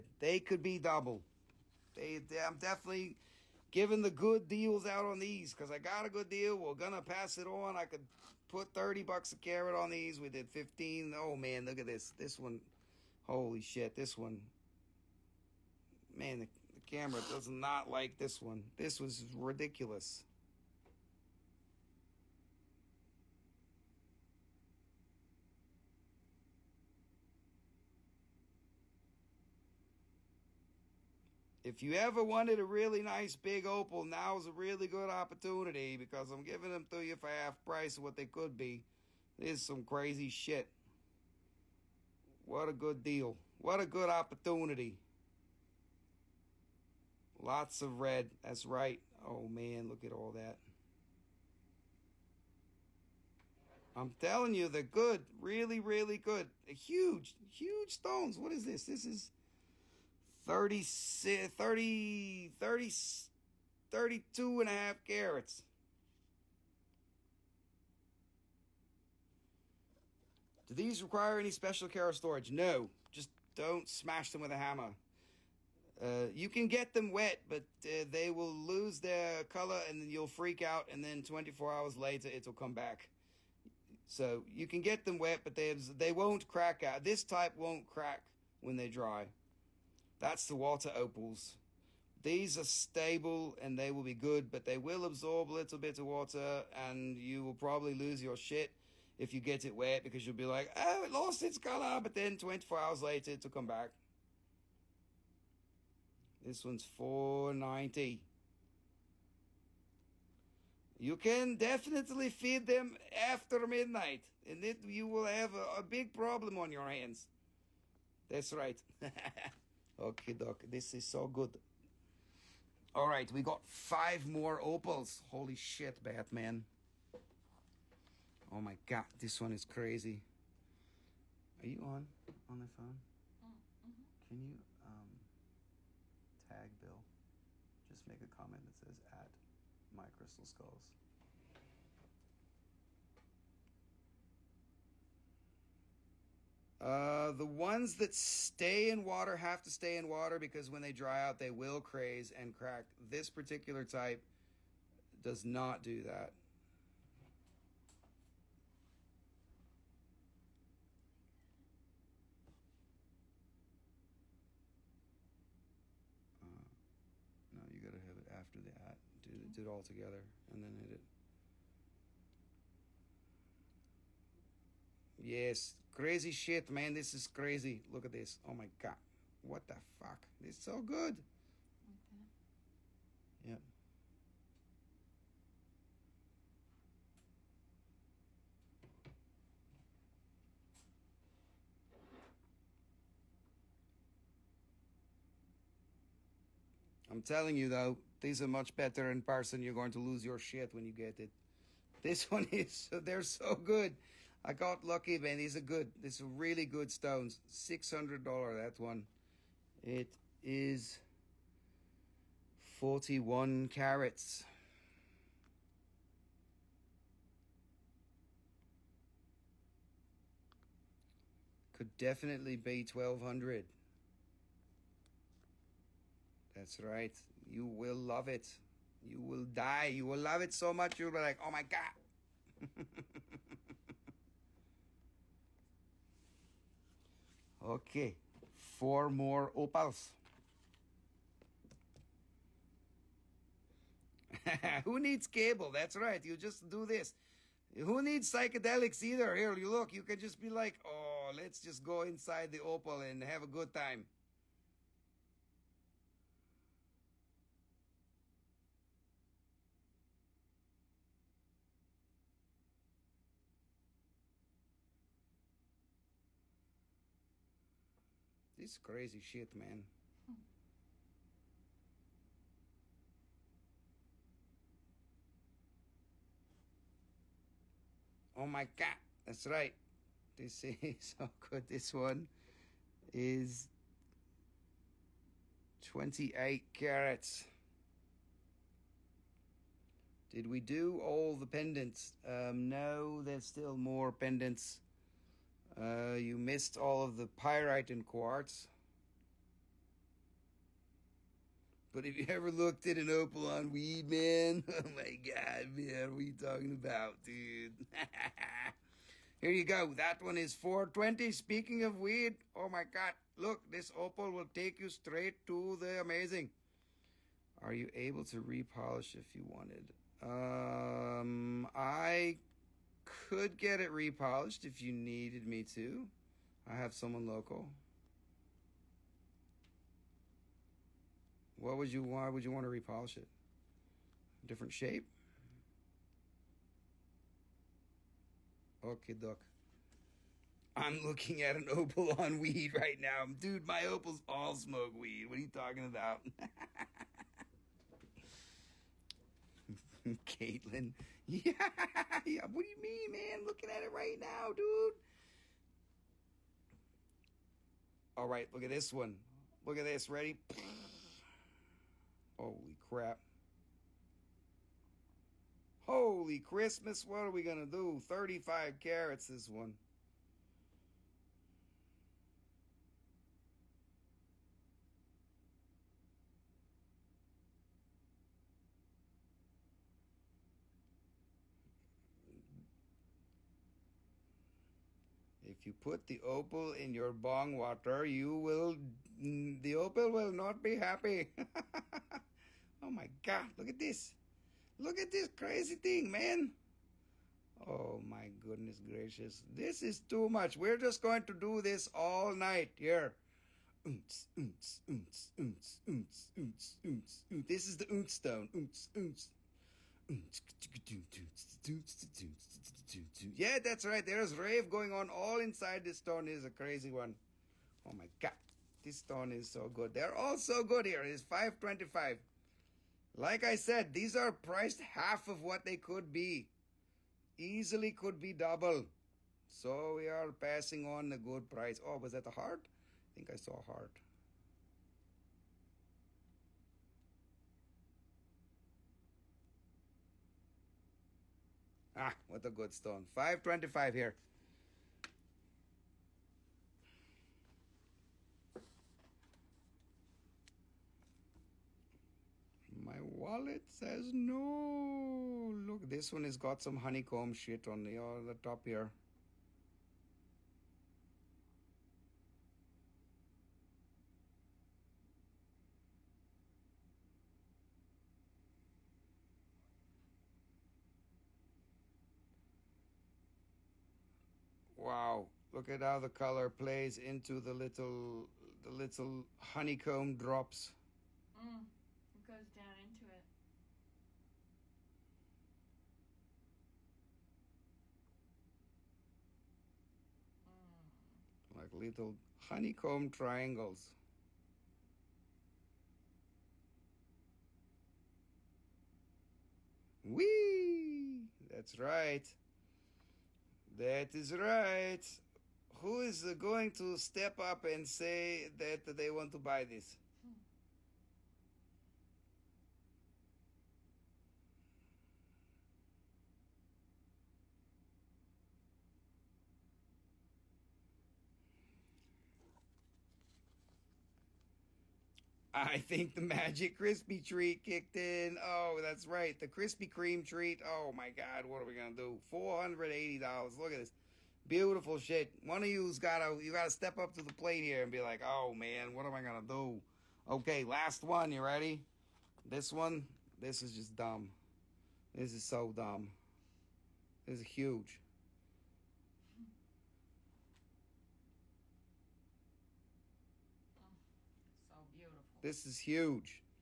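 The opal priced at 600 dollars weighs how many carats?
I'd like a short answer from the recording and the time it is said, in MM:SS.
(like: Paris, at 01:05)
41, at 03:32.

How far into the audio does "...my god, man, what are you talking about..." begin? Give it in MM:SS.
05:04.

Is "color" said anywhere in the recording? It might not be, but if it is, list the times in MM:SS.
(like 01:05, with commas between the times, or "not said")
01:19, 01:41, 07:56.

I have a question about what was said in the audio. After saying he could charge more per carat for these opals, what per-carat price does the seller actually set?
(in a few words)
15.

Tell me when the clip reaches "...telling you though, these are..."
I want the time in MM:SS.
03:17.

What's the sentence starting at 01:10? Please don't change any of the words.
Do these require any special care of storage?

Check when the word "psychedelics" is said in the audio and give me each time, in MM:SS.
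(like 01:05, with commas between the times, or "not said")
04:08.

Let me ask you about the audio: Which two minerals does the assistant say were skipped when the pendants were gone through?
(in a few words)
pyrite and quartz.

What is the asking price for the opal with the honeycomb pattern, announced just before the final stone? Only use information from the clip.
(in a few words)
$480.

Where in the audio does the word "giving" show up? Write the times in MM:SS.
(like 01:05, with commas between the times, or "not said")
00:03, 00:36.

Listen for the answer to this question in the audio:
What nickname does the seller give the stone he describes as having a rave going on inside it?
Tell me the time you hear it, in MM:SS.
06:47.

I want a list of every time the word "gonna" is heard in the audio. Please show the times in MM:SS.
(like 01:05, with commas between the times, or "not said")
00:06, 08:51, 08:59.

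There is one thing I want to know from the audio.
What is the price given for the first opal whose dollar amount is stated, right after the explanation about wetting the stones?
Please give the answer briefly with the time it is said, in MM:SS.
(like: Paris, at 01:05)
490, at 01:46.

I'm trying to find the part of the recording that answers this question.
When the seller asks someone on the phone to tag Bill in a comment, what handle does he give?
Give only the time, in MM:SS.
02:19.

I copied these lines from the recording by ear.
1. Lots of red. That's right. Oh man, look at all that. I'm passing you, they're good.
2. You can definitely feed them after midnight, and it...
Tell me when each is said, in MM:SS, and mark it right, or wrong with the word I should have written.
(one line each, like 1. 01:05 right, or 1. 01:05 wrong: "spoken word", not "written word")
1. 00:47 wrong: "telling", not "passing"
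2. 01:50 right.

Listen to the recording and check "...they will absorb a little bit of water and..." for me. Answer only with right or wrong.
right.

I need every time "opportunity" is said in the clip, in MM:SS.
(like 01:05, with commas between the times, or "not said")
00:35, 00:44.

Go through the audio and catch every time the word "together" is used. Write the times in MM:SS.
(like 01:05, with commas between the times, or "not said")
02:49.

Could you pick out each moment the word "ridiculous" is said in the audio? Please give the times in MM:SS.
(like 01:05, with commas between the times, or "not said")
00:19.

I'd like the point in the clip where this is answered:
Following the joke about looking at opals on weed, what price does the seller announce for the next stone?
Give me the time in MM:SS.
05:09.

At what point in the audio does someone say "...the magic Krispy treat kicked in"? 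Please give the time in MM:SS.
08:46.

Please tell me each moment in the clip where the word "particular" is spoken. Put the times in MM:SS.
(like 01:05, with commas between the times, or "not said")
02:33.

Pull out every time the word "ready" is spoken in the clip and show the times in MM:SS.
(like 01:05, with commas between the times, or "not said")
06:00, 09:01.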